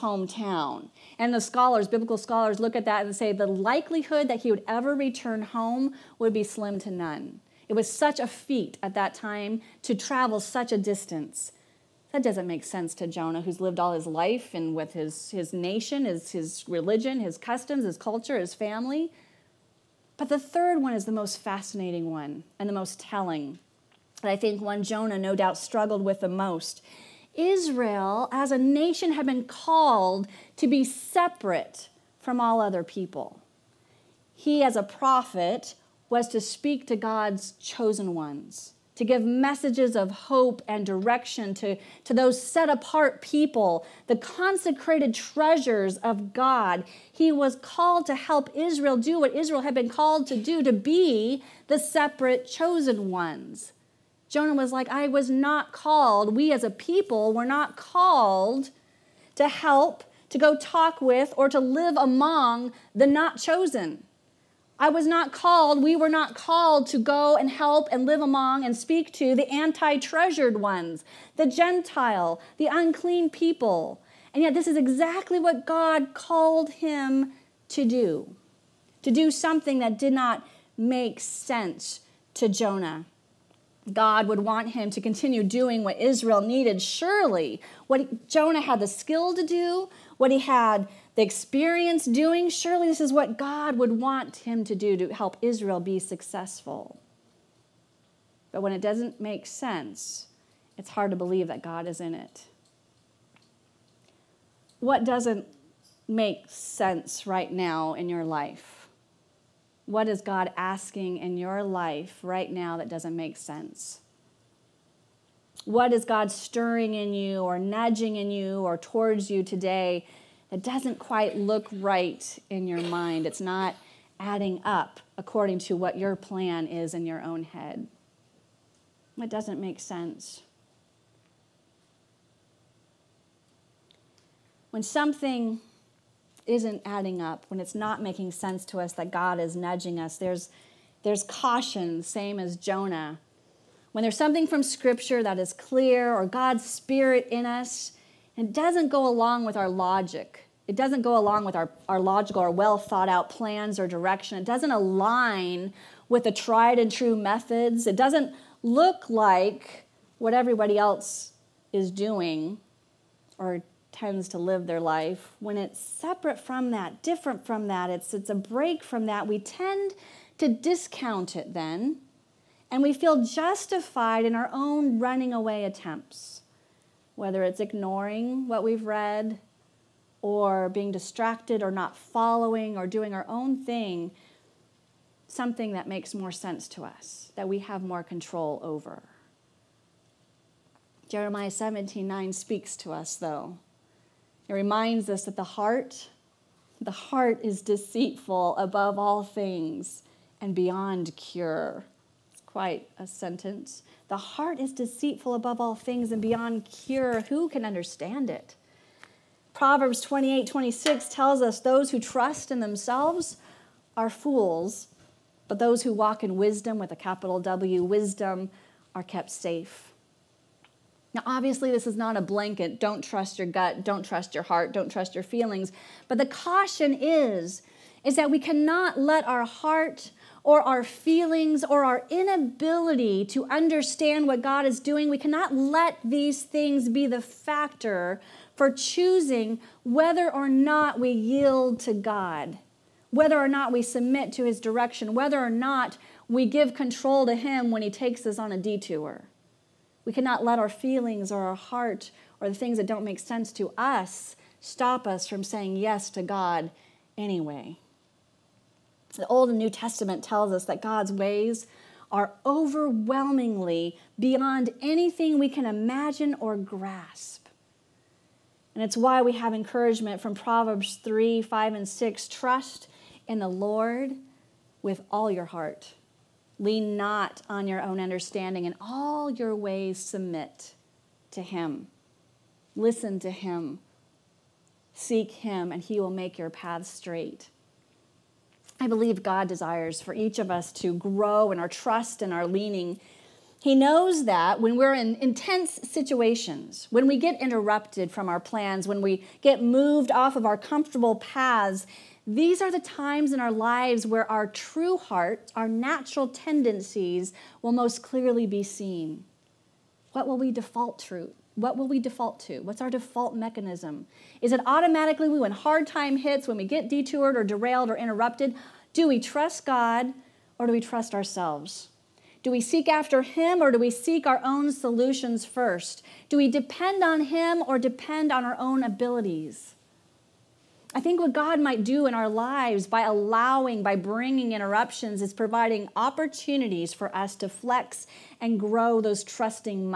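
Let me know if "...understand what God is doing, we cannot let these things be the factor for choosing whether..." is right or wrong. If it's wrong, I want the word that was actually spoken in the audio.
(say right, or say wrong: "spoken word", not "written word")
right.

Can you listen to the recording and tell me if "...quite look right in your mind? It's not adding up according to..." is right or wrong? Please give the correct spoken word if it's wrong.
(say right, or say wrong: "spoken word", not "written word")
right.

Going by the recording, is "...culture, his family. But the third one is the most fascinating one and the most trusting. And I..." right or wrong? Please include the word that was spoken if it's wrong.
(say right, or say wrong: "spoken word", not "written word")
wrong: "telling", not "trusting".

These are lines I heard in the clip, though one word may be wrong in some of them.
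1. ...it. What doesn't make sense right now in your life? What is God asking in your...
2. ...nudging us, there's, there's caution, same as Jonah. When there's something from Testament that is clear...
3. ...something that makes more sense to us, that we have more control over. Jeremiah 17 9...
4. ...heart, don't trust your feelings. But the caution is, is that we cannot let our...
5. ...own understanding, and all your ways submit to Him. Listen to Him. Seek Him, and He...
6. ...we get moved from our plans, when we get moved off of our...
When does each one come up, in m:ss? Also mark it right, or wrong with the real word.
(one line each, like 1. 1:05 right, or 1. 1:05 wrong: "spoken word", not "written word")
1. 1:42 right
2. 2:19 wrong: "Scripture", not "Testament"
3. 3:05 right
4. 3:44 right
5. 4:37 right
6. 4:57 wrong: "interrupted", not "moved".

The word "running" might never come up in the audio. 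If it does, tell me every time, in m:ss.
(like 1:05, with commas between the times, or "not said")
2:54.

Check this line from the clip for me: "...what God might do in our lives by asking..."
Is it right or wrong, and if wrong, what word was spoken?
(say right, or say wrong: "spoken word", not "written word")
wrong: "allowing", not "asking".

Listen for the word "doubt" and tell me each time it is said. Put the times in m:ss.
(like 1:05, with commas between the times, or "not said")
0:25.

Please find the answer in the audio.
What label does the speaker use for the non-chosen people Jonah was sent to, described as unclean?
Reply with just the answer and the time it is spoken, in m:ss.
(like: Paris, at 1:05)
the Gentile, at 1:11.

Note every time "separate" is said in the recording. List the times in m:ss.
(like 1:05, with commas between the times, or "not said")
0:30, 0:51, 2:45.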